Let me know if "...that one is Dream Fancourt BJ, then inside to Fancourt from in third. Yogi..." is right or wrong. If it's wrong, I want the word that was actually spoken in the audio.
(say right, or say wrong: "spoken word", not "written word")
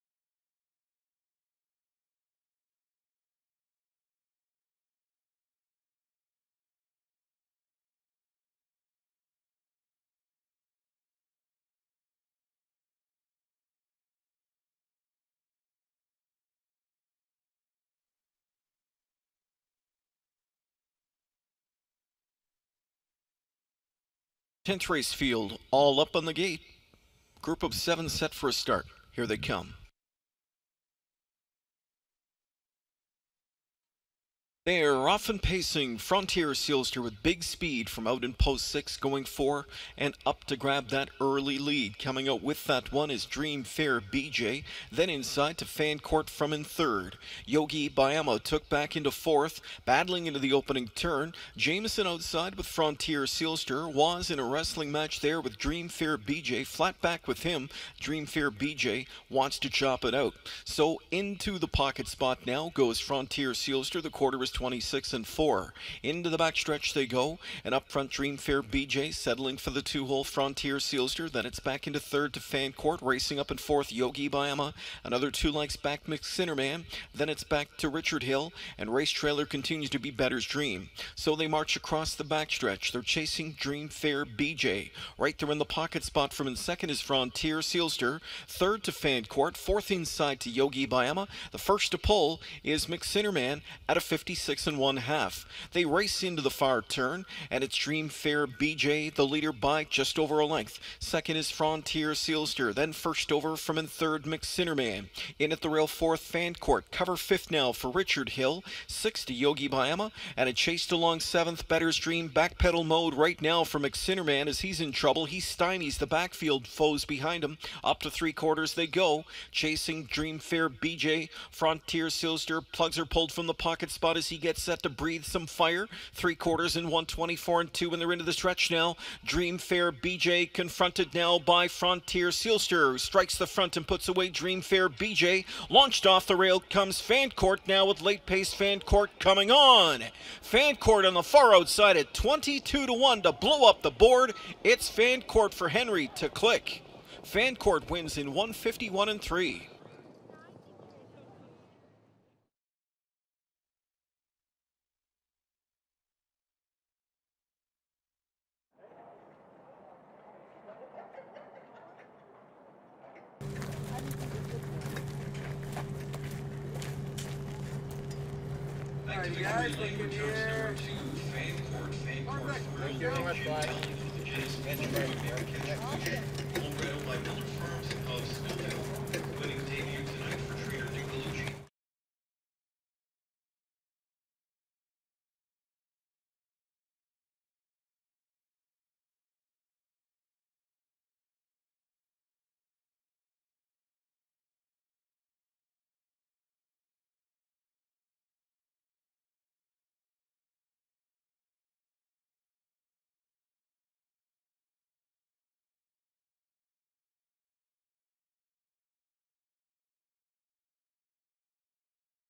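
wrong: "Fair", not "Fancourt".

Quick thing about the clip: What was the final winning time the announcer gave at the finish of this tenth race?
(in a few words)
1:51.3.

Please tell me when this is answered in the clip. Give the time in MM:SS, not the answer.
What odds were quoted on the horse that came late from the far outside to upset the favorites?
02:22.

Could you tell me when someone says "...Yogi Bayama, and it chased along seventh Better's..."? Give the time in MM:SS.
01:49.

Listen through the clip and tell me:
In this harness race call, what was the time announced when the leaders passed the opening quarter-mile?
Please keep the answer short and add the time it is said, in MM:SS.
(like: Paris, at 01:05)
26.4, at 01:04.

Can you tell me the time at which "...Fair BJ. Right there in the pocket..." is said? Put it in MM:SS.
01:23.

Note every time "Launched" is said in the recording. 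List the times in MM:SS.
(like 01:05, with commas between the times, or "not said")
02:15.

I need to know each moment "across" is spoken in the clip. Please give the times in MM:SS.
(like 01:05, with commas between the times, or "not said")
01:21.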